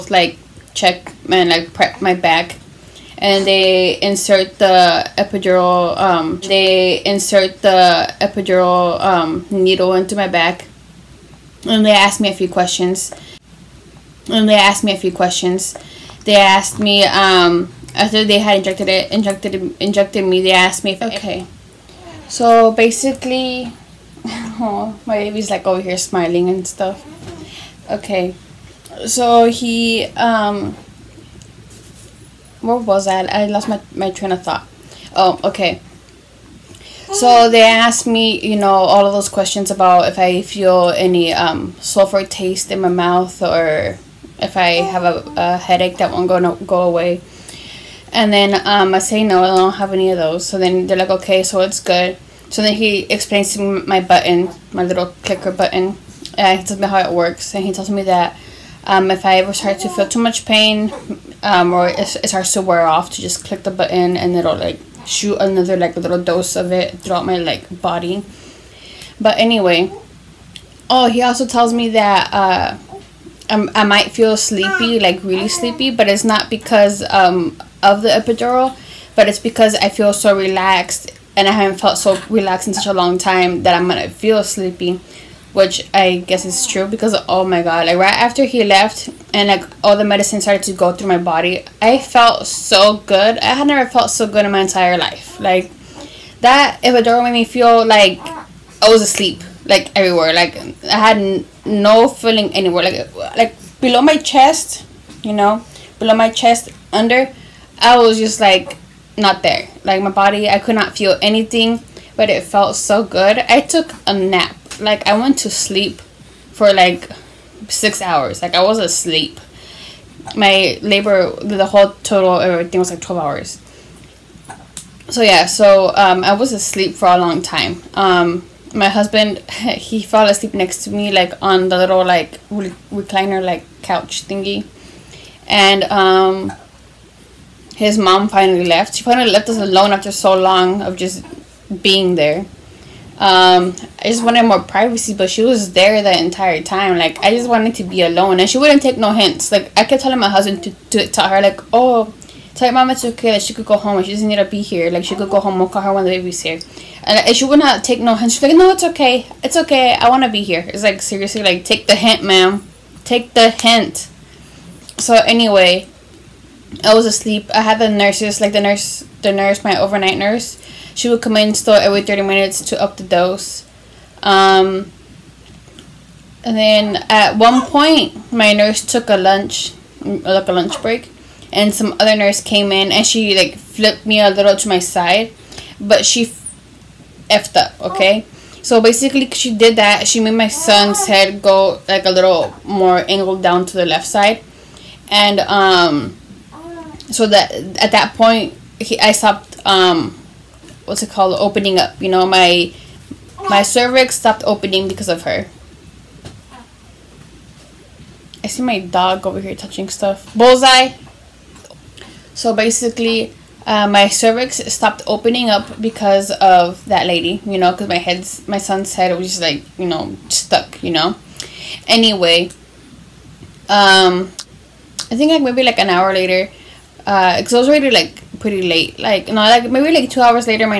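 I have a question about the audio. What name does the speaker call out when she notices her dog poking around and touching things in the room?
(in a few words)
Bullseye.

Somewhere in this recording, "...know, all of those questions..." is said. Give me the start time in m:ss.
0:38.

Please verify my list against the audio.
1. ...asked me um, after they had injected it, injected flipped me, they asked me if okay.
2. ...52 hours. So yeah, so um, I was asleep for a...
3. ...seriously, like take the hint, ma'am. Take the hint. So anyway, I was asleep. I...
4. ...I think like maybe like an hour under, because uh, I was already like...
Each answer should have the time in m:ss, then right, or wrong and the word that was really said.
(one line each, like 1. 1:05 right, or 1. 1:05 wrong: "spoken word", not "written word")
1. 0:16 wrong: "injected", not "flipped"
2. 2:03 wrong: "12", not "52"
3. 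2:41 right
4. 3:45 wrong: "later", not "under".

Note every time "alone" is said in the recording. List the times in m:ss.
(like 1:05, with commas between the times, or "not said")
2:19, 2:28.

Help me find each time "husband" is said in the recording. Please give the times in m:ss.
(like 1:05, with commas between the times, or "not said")
2:08, 2:30.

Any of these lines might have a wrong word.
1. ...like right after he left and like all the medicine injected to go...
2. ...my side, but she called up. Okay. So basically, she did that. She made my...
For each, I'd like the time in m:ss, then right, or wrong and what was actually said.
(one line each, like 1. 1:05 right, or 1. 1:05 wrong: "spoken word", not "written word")
1. 1:27 wrong: "started", not "injected"
2. 3:04 wrong: "effed", not "called".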